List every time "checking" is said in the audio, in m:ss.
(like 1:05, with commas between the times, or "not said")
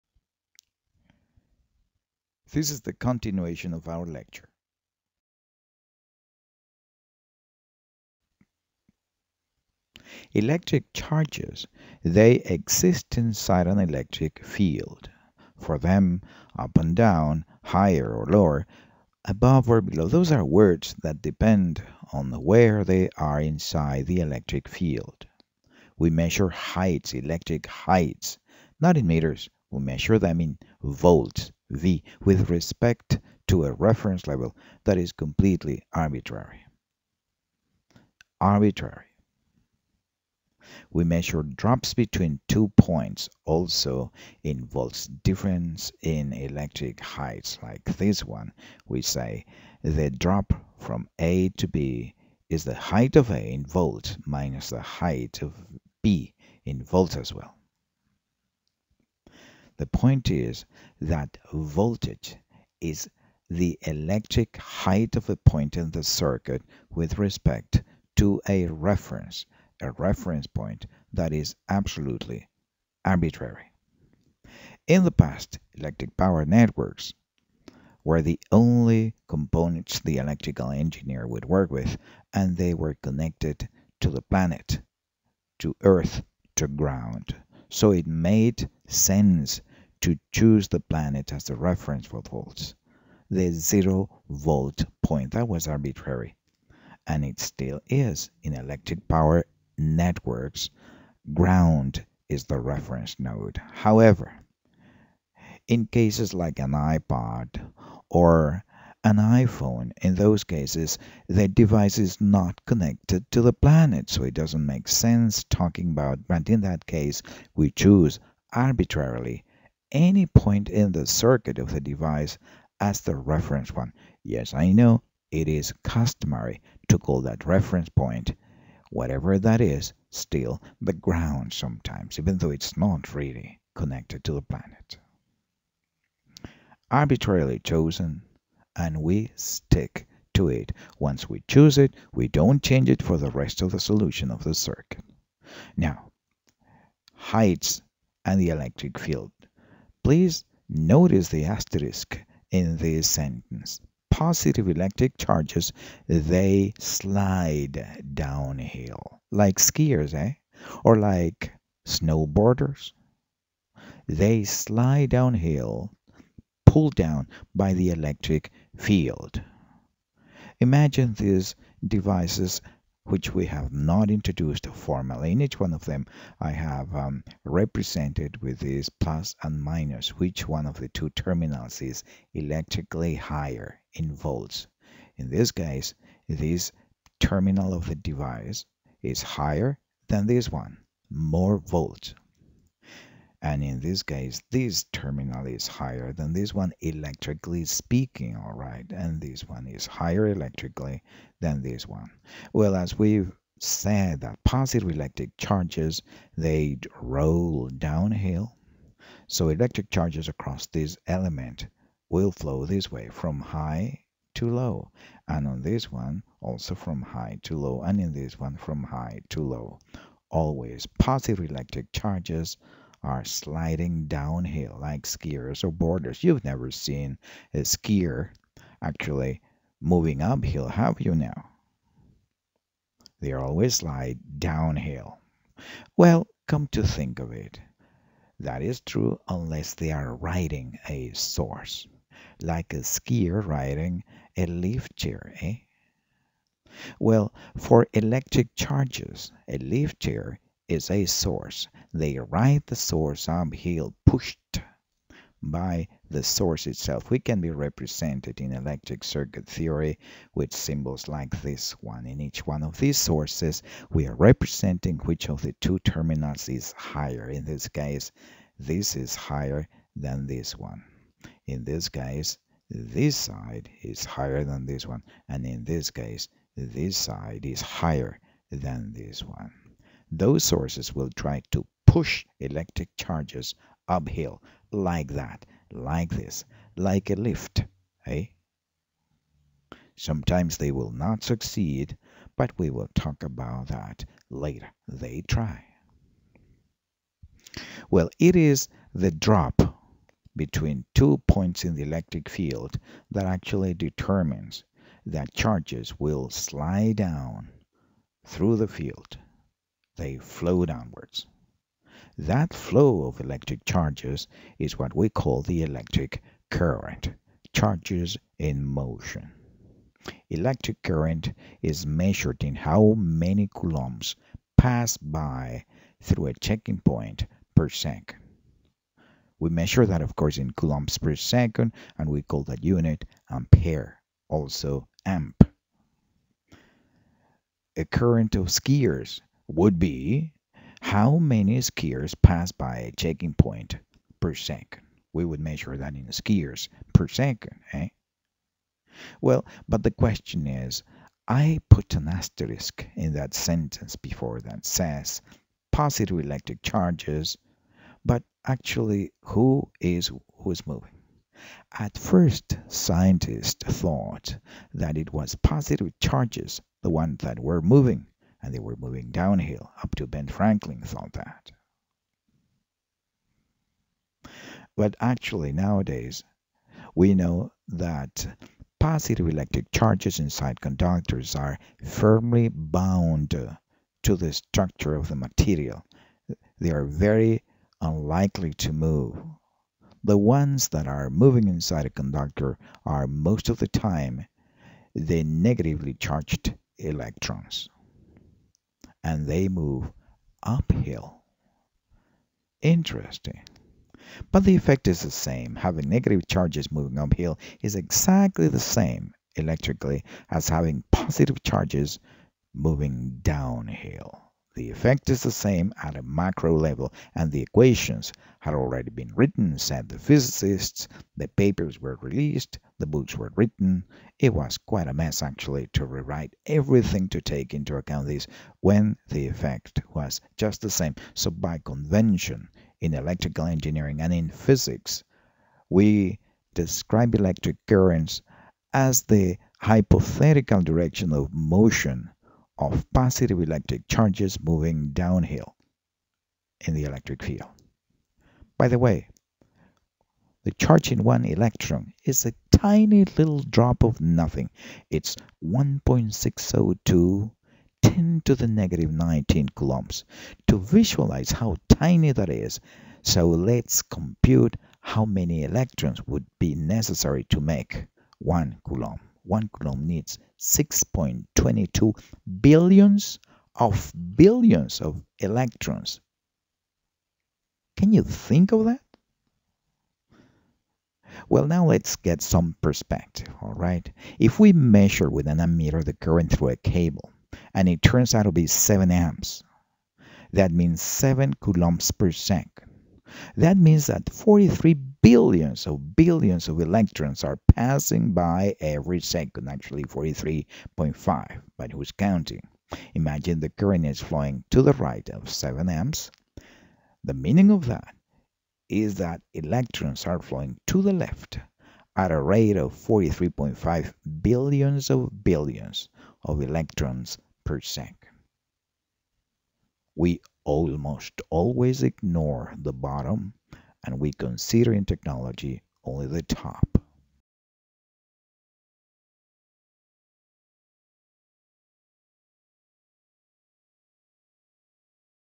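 5:26, 5:42.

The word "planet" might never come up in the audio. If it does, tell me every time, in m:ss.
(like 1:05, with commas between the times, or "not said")
1:24, 1:30, 1:53, 2:14.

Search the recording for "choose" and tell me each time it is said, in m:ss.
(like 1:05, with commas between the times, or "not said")
1:30, 1:57, 2:21.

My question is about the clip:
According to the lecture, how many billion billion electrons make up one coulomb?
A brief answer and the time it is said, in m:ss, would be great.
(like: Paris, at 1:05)
6.22, at 7:50.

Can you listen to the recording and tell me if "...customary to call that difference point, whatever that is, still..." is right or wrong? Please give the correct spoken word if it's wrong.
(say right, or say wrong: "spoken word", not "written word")
wrong: "reference", not "difference".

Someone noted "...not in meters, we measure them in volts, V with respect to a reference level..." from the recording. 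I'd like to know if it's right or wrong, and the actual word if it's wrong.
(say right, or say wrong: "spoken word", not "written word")
right.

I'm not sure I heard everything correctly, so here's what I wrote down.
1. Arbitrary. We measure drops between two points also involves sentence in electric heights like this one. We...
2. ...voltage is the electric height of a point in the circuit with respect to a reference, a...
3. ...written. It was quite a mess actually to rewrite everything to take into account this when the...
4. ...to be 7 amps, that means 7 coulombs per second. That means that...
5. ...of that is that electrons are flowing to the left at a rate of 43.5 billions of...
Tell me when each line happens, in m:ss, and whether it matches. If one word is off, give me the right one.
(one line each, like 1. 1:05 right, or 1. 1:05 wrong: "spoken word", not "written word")
1. 0:38 wrong: "difference", not "sentence"
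2. 1:01 right
3. 7:03 right
4. 8:08 right
5. 8:27 right.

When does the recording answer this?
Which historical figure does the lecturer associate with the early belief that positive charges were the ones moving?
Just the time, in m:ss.
6:10.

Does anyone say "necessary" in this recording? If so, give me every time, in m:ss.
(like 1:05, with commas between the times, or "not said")
7:46.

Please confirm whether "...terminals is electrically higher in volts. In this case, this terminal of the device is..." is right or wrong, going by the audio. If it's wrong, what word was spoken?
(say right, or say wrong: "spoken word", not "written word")
right.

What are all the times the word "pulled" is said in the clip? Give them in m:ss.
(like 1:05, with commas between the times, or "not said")
2:46.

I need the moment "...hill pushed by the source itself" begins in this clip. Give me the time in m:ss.
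4:13.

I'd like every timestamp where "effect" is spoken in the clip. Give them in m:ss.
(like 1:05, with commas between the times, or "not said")
6:44, 6:54, 7:09.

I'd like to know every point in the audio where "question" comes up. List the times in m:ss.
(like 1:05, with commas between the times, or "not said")
5:49.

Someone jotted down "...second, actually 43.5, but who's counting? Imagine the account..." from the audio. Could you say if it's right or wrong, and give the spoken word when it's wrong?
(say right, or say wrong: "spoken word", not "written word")
wrong: "current", not "account".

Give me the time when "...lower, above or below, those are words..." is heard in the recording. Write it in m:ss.
0:18.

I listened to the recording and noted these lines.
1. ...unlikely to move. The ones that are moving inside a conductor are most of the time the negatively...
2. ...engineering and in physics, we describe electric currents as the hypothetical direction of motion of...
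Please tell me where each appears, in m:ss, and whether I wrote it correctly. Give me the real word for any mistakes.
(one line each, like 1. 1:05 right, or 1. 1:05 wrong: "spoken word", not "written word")
1. 6:27 right
2. 7:13 right.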